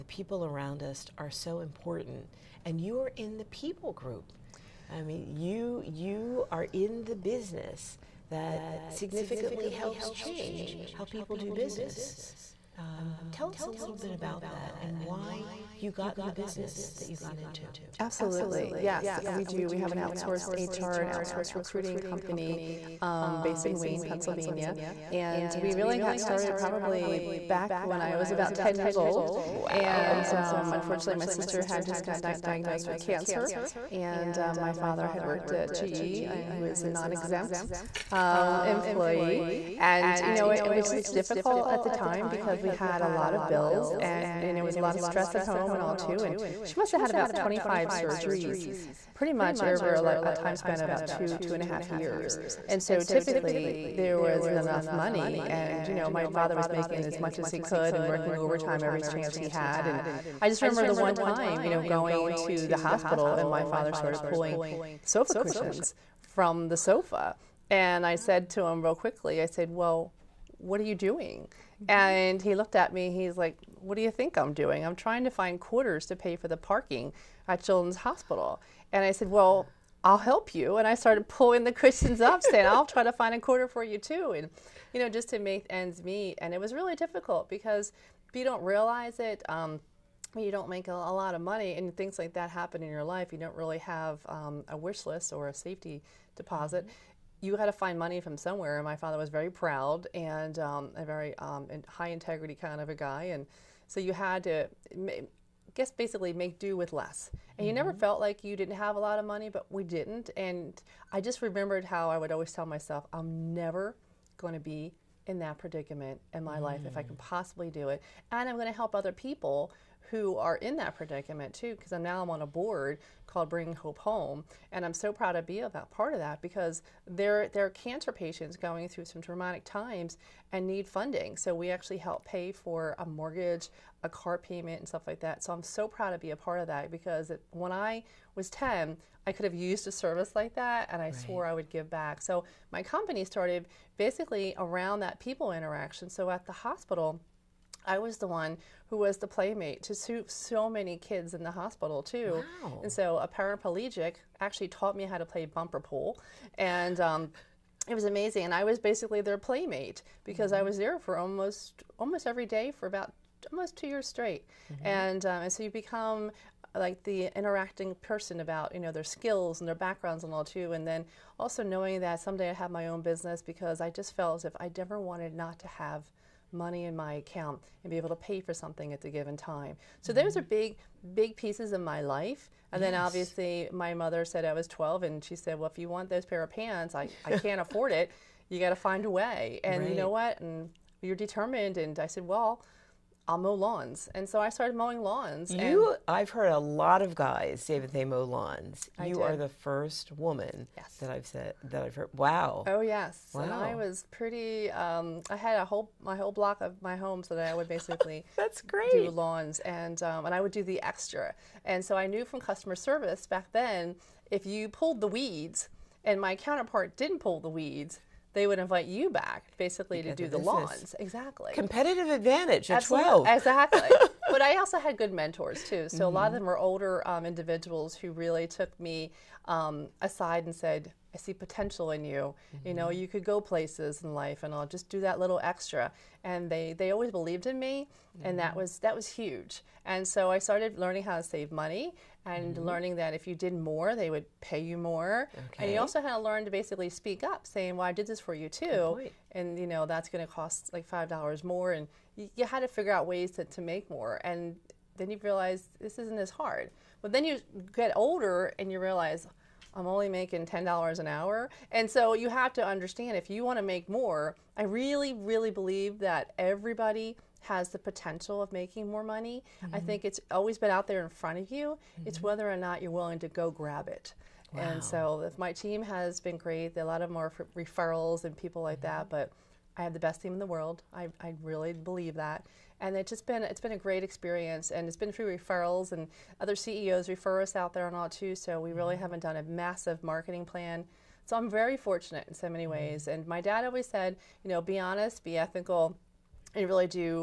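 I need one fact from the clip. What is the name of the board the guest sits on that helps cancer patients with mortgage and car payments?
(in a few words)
Bring Hope Home.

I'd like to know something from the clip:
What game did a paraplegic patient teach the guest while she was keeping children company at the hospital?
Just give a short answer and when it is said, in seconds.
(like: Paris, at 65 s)
bumper pool, at 155 s.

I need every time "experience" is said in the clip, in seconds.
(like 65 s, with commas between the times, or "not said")
284 s.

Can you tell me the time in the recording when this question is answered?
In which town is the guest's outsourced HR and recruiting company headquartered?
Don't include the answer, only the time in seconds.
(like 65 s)
23 s.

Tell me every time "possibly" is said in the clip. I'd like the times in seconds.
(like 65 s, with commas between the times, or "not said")
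117 s.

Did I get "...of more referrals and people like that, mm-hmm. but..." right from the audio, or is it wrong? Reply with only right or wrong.
right.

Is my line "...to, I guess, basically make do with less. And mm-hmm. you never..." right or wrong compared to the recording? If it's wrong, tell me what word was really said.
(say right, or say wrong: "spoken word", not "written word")
right.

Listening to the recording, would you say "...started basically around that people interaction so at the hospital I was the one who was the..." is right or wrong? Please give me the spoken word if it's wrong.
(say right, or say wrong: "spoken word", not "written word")
right.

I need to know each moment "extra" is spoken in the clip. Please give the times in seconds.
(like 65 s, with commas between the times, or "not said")
210 s, 235 s.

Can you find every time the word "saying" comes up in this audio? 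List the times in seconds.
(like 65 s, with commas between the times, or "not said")
82 s, 247 s.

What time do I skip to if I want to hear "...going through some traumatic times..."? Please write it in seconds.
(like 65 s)
128 s.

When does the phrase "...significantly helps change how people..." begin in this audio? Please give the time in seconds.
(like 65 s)
8 s.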